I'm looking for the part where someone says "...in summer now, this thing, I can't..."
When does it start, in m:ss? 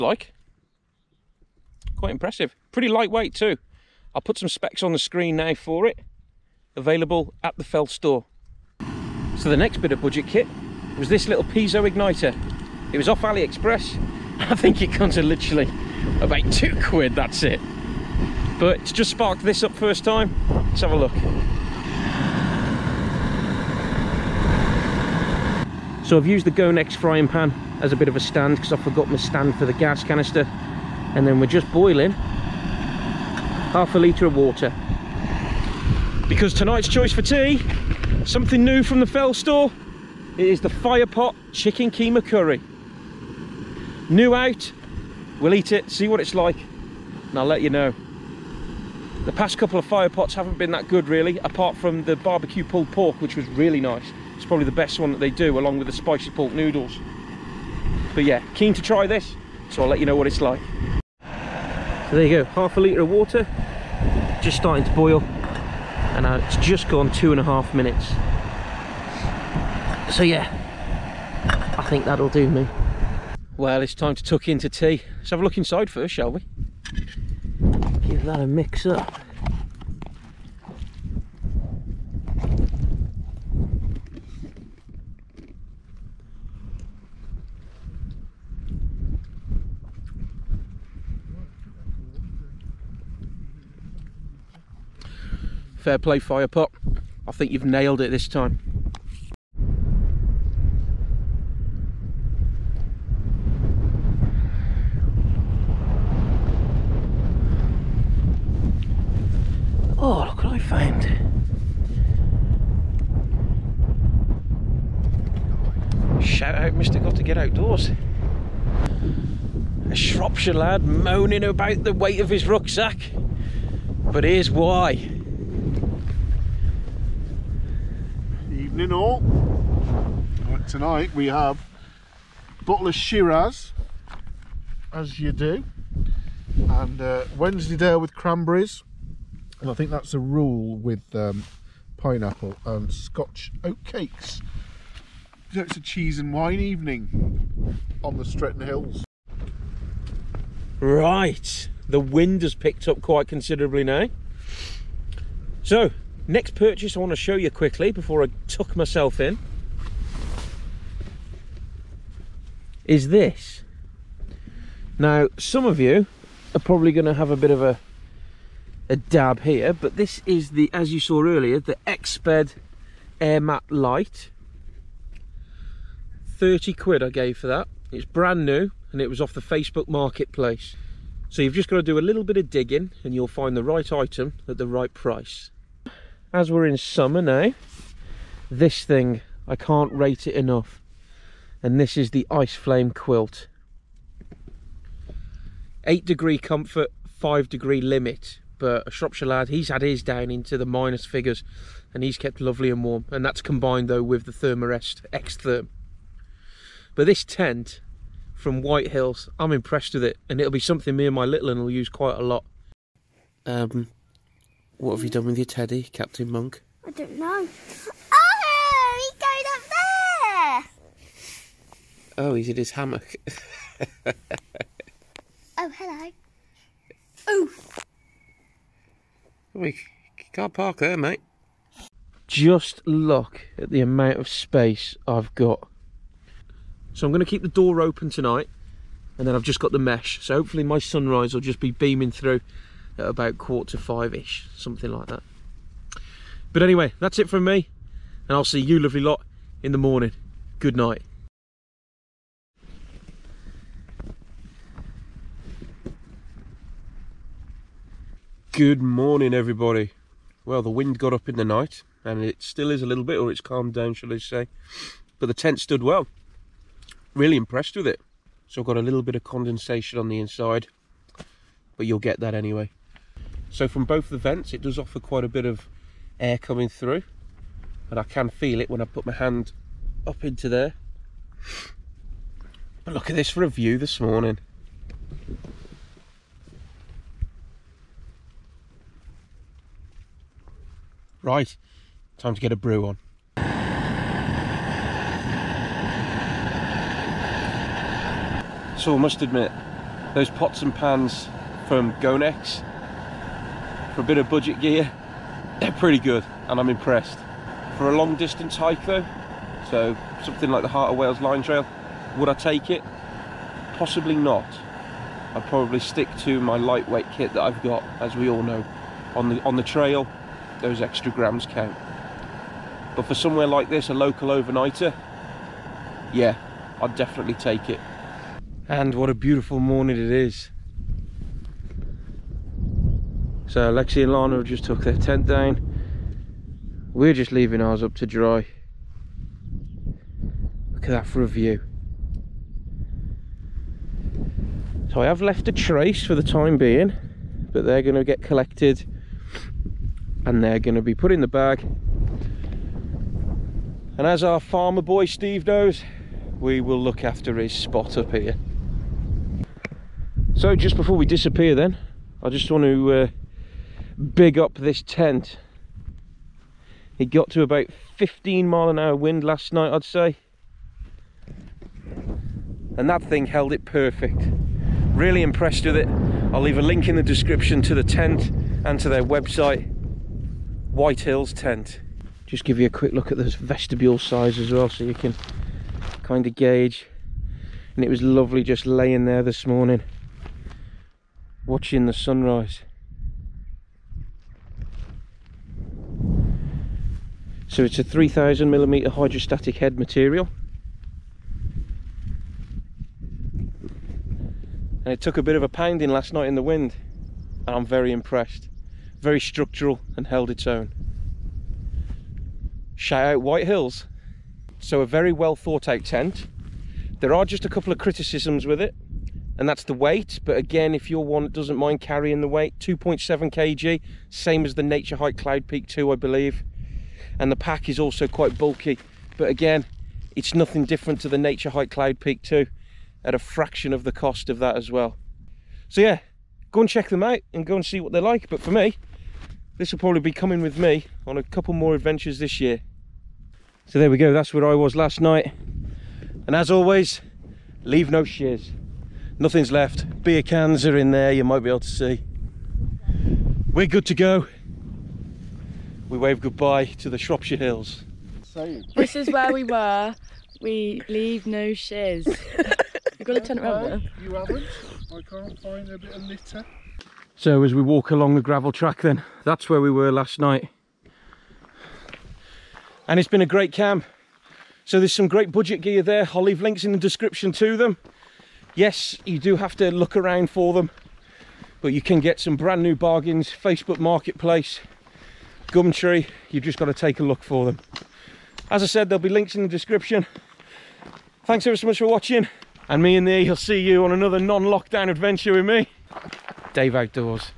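3:06.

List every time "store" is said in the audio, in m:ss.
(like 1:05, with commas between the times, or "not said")
0:07, 0:39.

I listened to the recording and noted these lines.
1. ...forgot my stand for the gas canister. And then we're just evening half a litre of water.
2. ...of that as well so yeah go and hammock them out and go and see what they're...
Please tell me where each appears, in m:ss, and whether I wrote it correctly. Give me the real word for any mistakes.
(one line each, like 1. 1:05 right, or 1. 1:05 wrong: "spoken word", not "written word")
1. 0:28 wrong: "boiling", not "evening"
2. 7:14 wrong: "check", not "hammock".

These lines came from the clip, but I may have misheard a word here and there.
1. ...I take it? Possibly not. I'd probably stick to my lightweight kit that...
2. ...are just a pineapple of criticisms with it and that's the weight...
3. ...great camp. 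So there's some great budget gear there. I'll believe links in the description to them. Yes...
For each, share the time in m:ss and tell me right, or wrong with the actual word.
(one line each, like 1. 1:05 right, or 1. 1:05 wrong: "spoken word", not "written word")
1. 5:12 right
2. 6:57 wrong: "couple", not "pineapple"
3. 7:53 wrong: "leave", not "believe".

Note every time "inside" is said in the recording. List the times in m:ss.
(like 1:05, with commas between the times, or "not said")
1:15, 4:30.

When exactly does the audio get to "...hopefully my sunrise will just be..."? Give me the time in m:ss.
4:00.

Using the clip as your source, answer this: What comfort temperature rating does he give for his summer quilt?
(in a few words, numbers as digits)
8 degrees.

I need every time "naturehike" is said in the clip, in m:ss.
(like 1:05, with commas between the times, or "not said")
7:04, 7:11.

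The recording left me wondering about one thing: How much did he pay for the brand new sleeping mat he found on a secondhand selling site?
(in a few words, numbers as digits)
30 quid.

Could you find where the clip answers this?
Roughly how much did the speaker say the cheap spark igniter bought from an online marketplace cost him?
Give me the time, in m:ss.
0:16.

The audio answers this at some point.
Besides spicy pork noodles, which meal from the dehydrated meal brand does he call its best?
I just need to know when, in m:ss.
0:52.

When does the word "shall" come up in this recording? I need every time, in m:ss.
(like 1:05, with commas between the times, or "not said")
1:16, 4:23.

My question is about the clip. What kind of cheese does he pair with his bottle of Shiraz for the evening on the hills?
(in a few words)
Wensleydale with cranberries.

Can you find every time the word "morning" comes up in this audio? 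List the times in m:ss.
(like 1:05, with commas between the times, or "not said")
4:09, 4:18, 4:44, 5:29, 6:29.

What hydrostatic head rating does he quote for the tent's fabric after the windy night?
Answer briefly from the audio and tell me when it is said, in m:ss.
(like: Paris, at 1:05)
3000 millimeters, at 6:37.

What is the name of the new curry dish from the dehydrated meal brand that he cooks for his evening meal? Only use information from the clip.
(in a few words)
Chicken Keema Curry.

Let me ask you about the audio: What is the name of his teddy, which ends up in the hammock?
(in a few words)
Captain Monk.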